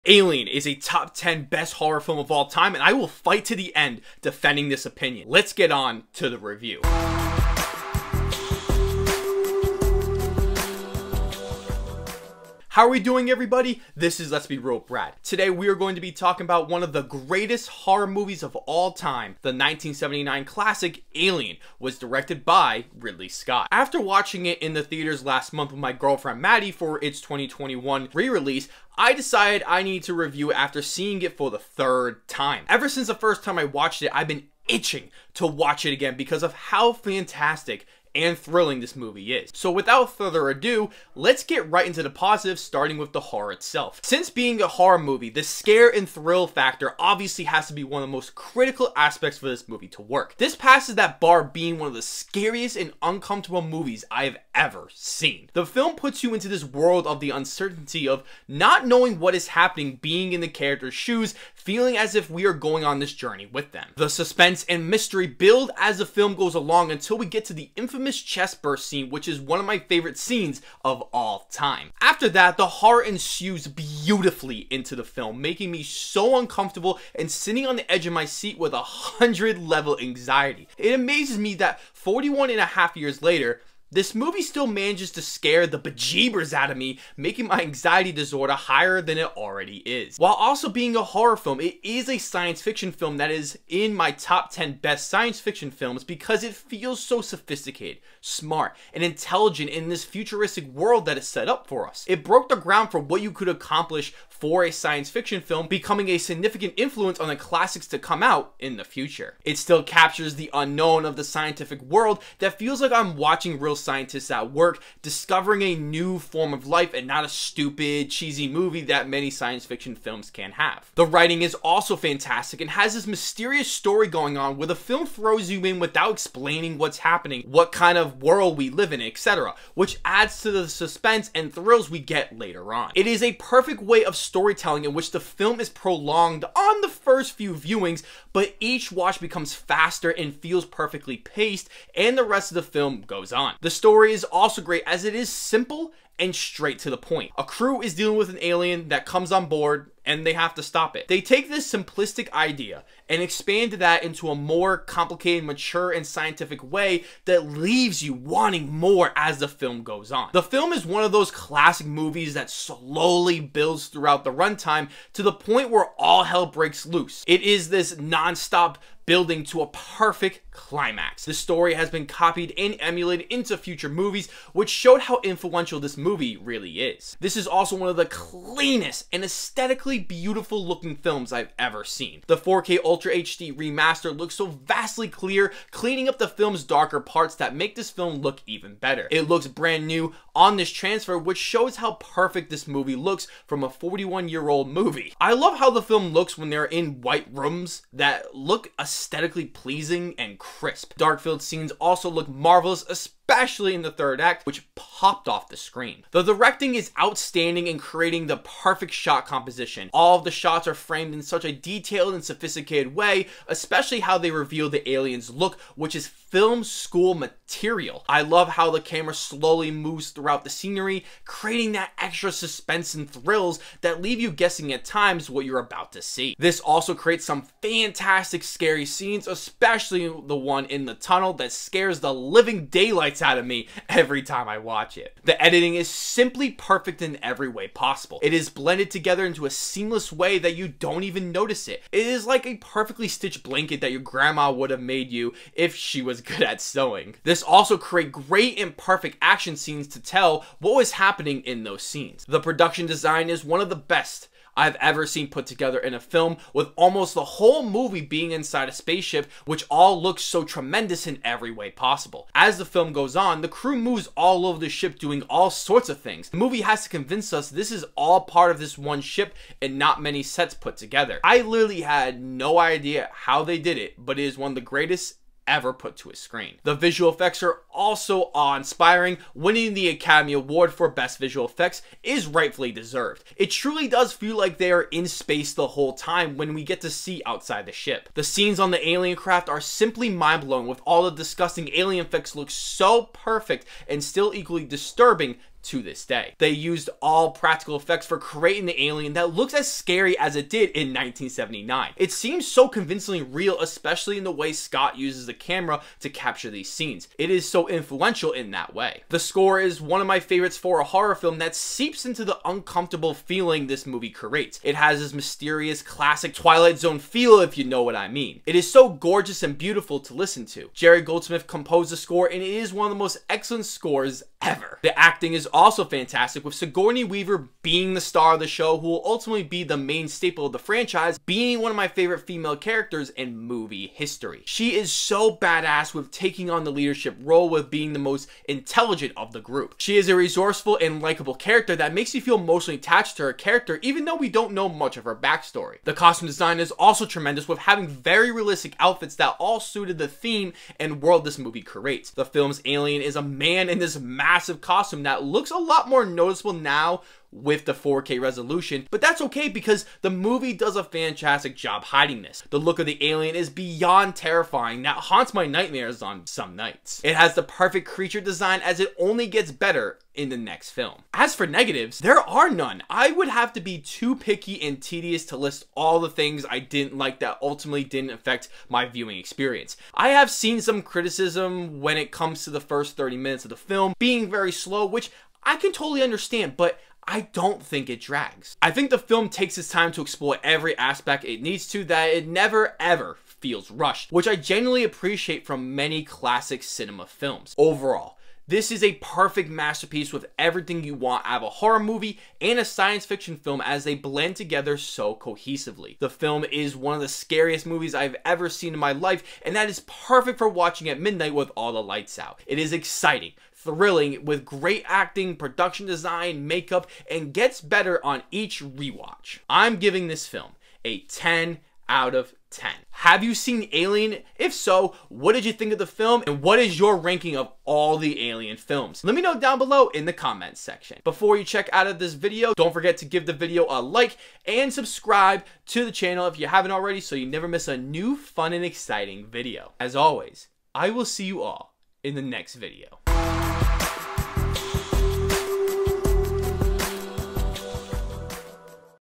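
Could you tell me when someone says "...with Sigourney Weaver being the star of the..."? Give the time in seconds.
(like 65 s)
326 s.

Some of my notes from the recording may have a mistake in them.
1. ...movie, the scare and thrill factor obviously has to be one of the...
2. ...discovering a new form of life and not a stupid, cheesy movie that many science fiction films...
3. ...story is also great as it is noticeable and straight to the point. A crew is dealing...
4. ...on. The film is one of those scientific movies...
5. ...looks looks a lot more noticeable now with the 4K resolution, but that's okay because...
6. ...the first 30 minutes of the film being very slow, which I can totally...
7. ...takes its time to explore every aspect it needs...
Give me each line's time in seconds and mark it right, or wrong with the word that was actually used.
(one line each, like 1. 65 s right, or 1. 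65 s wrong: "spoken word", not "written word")
1. 44 s right
2. 115 s right
3. 143 s wrong: "simple", not "noticeable"
4. 160 s wrong: "classic", not "scientific"
5. 355 s right
6. 382 s right
7. 389 s right.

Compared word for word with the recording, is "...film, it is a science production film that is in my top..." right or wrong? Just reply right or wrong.
wrong.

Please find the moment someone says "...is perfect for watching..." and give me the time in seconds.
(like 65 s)
409 s.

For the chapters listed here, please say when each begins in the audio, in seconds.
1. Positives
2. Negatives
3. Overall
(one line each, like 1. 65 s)
1. 39 s
2. 371 s
3. 397 s.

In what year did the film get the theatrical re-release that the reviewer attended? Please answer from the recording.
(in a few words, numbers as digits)
2021.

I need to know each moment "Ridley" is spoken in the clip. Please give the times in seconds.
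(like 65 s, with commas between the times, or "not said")
22 s.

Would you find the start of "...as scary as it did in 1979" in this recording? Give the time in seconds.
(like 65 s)
299 s.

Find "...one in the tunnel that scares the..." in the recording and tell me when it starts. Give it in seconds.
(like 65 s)
230 s.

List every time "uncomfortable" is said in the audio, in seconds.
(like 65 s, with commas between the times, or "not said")
53 s, 76 s, 312 s.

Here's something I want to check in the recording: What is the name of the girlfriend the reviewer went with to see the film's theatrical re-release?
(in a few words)
Maddie.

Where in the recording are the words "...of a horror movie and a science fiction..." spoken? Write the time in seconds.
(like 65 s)
401 s.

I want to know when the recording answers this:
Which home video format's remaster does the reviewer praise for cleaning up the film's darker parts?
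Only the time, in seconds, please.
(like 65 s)
182 s.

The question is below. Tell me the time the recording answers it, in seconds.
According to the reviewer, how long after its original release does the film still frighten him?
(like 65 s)
81 s.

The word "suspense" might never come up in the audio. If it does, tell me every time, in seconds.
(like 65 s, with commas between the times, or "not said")
64 s, 130 s, 222 s.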